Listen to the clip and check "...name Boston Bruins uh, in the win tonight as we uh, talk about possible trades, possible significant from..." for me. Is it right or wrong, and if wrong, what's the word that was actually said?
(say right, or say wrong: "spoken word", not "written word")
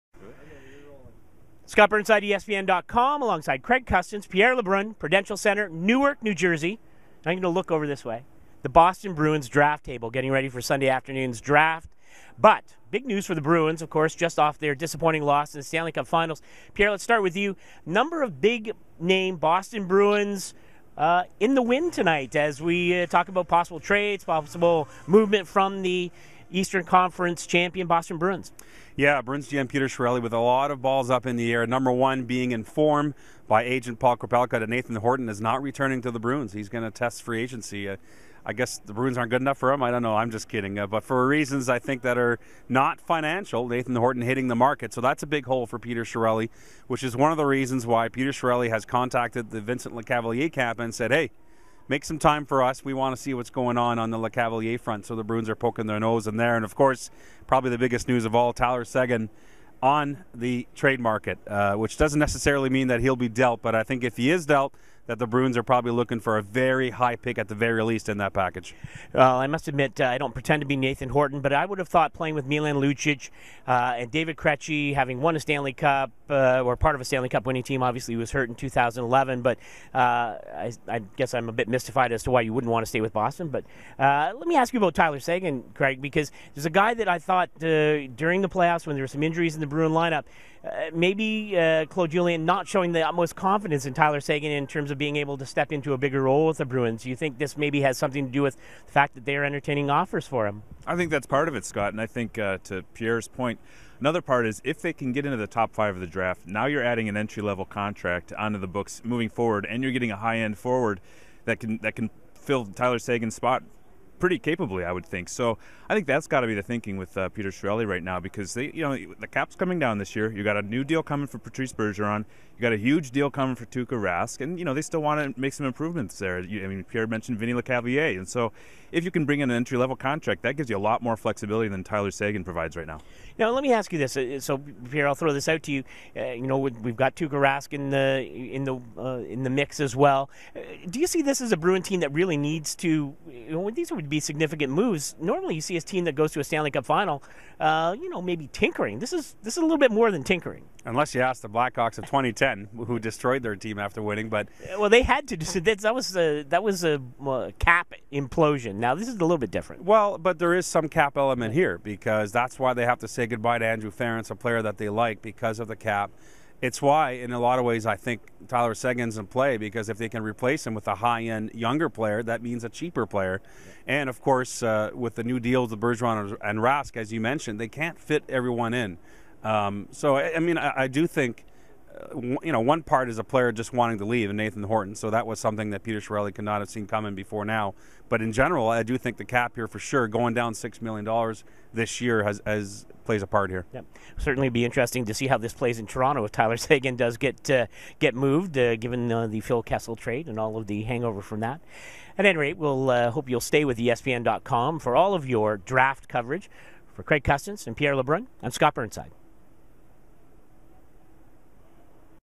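wrong: "movement", not "significant".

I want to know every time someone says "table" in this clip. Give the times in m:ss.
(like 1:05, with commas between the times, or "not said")
0:09.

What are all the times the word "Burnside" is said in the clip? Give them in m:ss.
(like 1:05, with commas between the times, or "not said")
0:01, 3:28.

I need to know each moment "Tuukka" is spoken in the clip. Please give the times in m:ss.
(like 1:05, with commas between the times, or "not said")
2:03, 2:17.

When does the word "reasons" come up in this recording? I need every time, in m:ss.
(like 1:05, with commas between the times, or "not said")
0:41, 0:47.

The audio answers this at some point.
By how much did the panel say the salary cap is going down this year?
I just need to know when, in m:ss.
3:10.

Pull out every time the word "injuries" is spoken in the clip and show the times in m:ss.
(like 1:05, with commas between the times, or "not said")
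1:29.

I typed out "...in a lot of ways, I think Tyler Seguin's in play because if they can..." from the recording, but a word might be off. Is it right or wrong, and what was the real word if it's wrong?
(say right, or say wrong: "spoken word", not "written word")
right.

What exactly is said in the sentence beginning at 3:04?
So that was something that Peter Chiarelli could not have seen coming before now.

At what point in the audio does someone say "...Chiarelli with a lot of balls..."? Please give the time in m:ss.
0:29.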